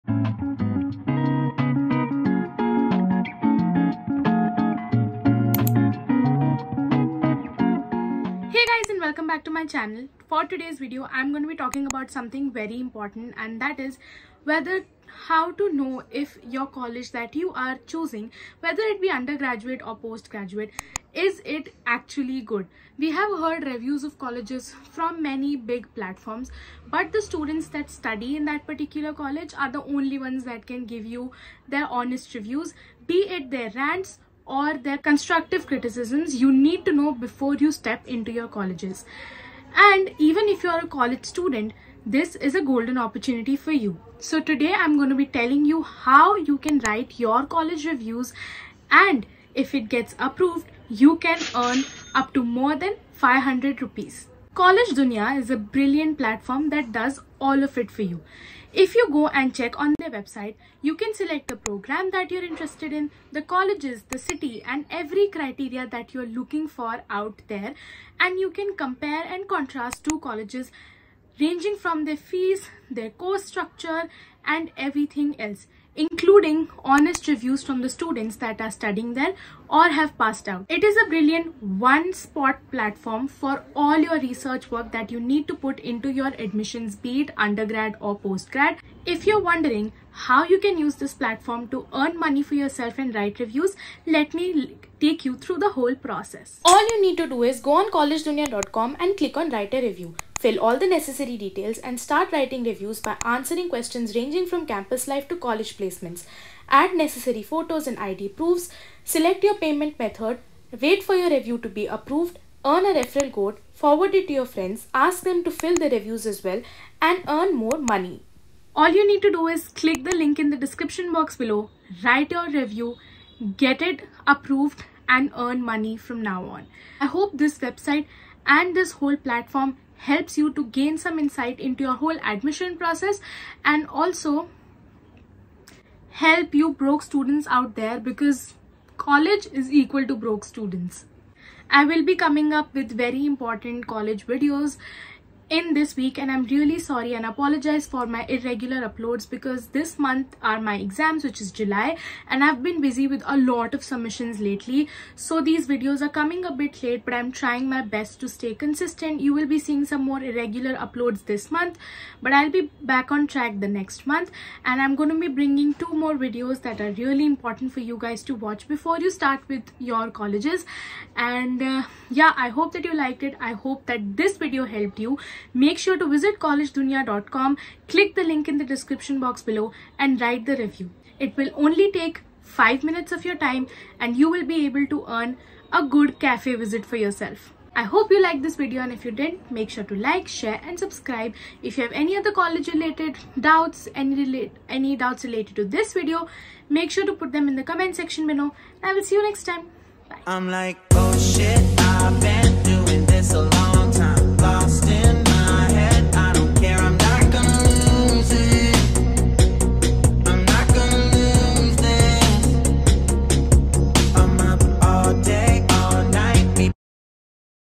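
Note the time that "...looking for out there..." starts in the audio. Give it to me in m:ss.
1:06.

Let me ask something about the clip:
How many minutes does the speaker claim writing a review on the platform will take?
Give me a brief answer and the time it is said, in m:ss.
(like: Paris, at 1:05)
5 minutes, at 3:02.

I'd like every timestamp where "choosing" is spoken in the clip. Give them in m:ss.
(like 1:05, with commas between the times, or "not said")
0:17.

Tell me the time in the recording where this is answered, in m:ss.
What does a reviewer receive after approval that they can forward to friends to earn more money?
1:52.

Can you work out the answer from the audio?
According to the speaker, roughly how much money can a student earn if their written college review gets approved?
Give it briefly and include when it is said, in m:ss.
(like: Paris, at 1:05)
500 rupees, at 0:53.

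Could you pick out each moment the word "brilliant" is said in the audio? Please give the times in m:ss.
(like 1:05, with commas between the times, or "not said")
0:55, 1:21.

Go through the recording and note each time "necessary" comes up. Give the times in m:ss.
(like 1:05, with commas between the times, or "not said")
1:40, 1:46.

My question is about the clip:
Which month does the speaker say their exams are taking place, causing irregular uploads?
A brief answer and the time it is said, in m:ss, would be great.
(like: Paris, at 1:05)
July, at 2:31.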